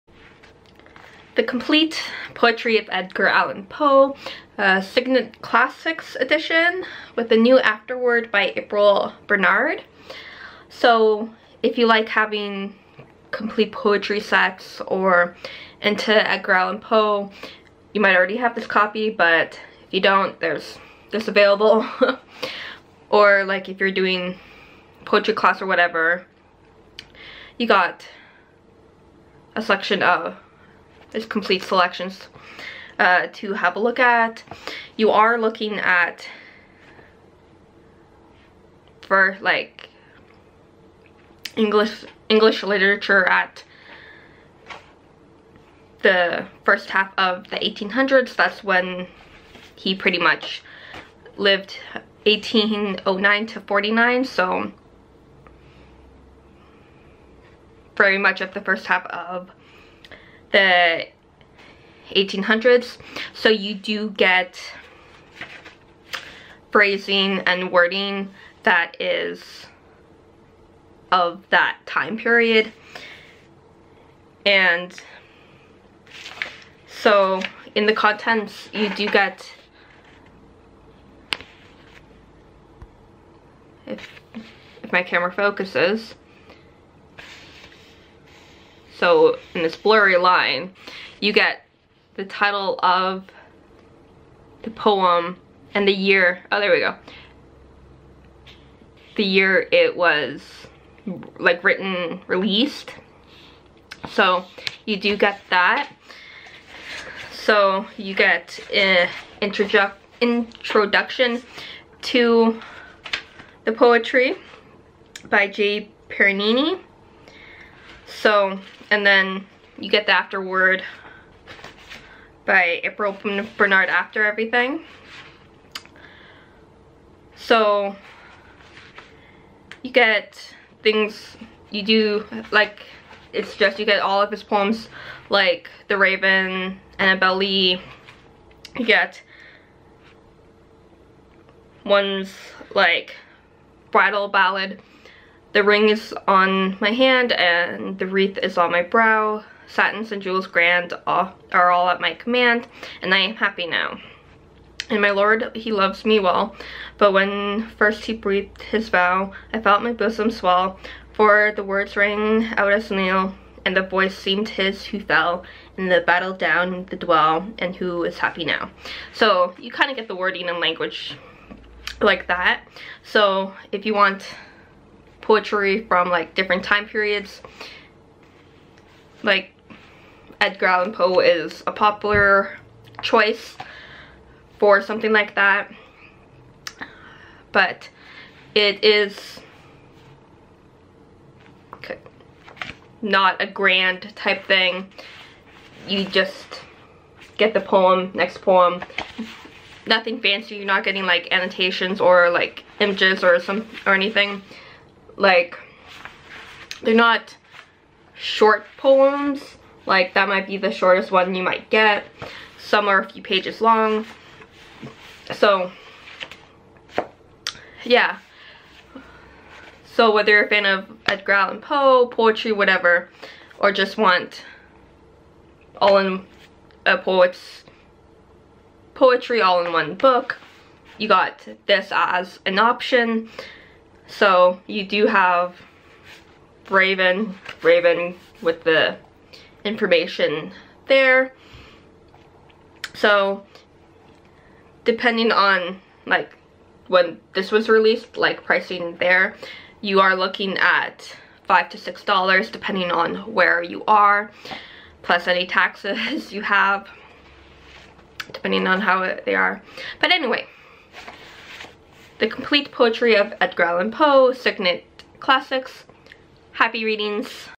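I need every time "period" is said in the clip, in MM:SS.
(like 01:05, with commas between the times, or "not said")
01:12, 02:56.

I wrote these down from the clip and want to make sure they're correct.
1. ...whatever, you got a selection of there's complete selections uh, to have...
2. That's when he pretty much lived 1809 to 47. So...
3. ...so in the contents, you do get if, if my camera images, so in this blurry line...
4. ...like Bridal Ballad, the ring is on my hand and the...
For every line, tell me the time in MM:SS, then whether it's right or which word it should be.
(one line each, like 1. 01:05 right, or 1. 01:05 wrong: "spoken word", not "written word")
1. 00:25 right
2. 00:48 wrong: "49", not "47"
3. 01:16 wrong: "focuses", not "images"
4. 02:22 right.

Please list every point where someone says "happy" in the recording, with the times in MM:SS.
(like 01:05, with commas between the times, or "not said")
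02:33, 02:48, 04:26.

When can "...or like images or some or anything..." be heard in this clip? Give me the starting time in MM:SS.
03:21.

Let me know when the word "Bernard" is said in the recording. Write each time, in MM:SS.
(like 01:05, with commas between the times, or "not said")
00:09, 02:03.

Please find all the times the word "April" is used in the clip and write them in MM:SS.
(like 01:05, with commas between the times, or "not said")
00:08, 02:02.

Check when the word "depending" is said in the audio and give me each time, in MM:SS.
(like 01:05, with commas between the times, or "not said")
04:04, 04:12, 04:18.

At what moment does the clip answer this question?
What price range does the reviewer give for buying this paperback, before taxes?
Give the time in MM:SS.
04:11.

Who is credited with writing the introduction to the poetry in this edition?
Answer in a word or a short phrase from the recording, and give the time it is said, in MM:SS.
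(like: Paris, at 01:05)
J. Parini, at 01:55.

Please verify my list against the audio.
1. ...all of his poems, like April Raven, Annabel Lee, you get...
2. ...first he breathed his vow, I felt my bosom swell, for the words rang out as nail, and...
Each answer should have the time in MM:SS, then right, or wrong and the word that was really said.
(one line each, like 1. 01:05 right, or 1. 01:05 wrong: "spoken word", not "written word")
1. 02:14 wrong: "The", not "April"
2. 02:37 right.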